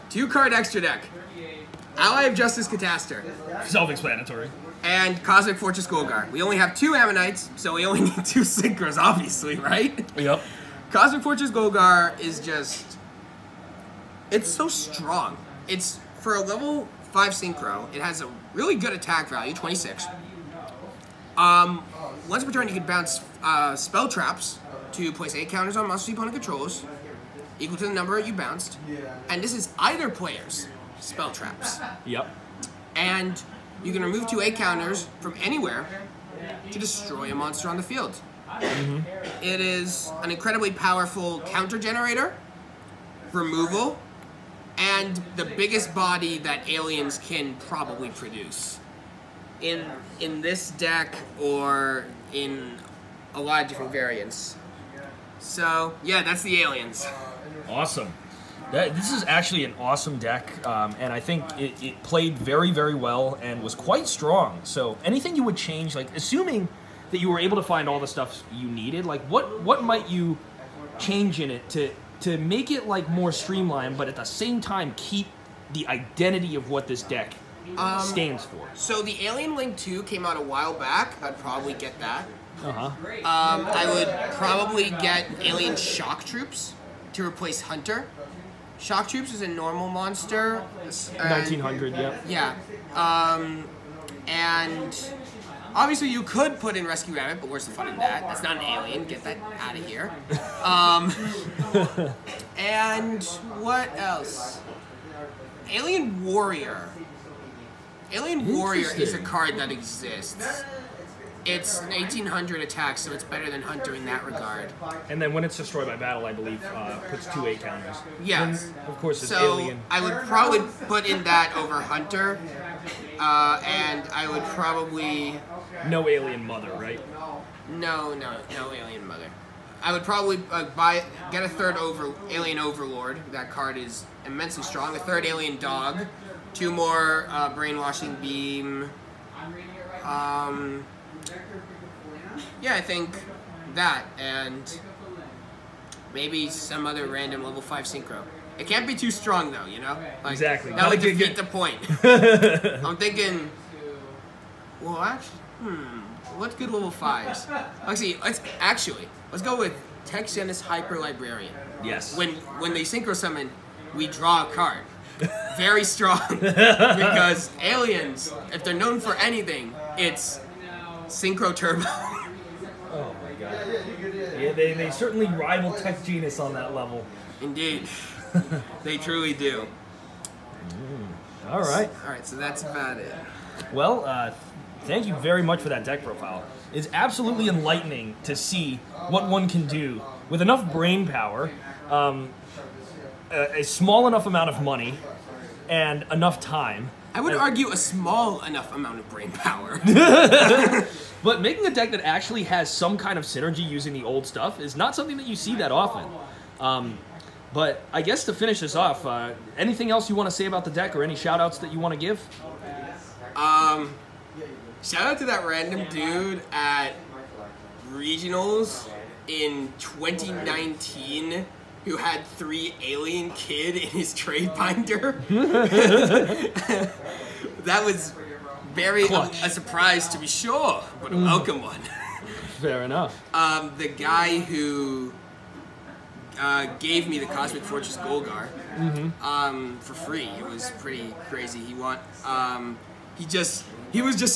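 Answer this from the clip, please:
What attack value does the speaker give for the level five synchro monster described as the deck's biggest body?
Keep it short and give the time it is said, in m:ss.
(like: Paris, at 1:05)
2600, at 0:19.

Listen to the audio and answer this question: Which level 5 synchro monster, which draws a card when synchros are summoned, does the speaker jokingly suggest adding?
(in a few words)
Tech Genus Hyper Librarian.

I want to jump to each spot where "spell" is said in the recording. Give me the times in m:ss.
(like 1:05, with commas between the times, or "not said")
0:23, 0:31.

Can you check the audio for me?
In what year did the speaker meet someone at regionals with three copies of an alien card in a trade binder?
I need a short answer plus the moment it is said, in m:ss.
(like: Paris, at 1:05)
2019, at 3:39.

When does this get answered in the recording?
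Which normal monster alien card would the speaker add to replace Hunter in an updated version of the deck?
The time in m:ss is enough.
1:25.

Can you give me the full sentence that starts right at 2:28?
It can't be too strong though, you know?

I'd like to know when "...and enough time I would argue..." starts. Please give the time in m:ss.
3:15.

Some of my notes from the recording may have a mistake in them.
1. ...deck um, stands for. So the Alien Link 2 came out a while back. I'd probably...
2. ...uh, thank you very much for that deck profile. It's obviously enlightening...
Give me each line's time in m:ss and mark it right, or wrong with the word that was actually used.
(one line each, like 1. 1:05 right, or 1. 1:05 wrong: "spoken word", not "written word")
1. 1:17 right
2. 3:04 wrong: "absolutely", not "obviously".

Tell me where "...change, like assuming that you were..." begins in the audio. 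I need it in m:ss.
1:05.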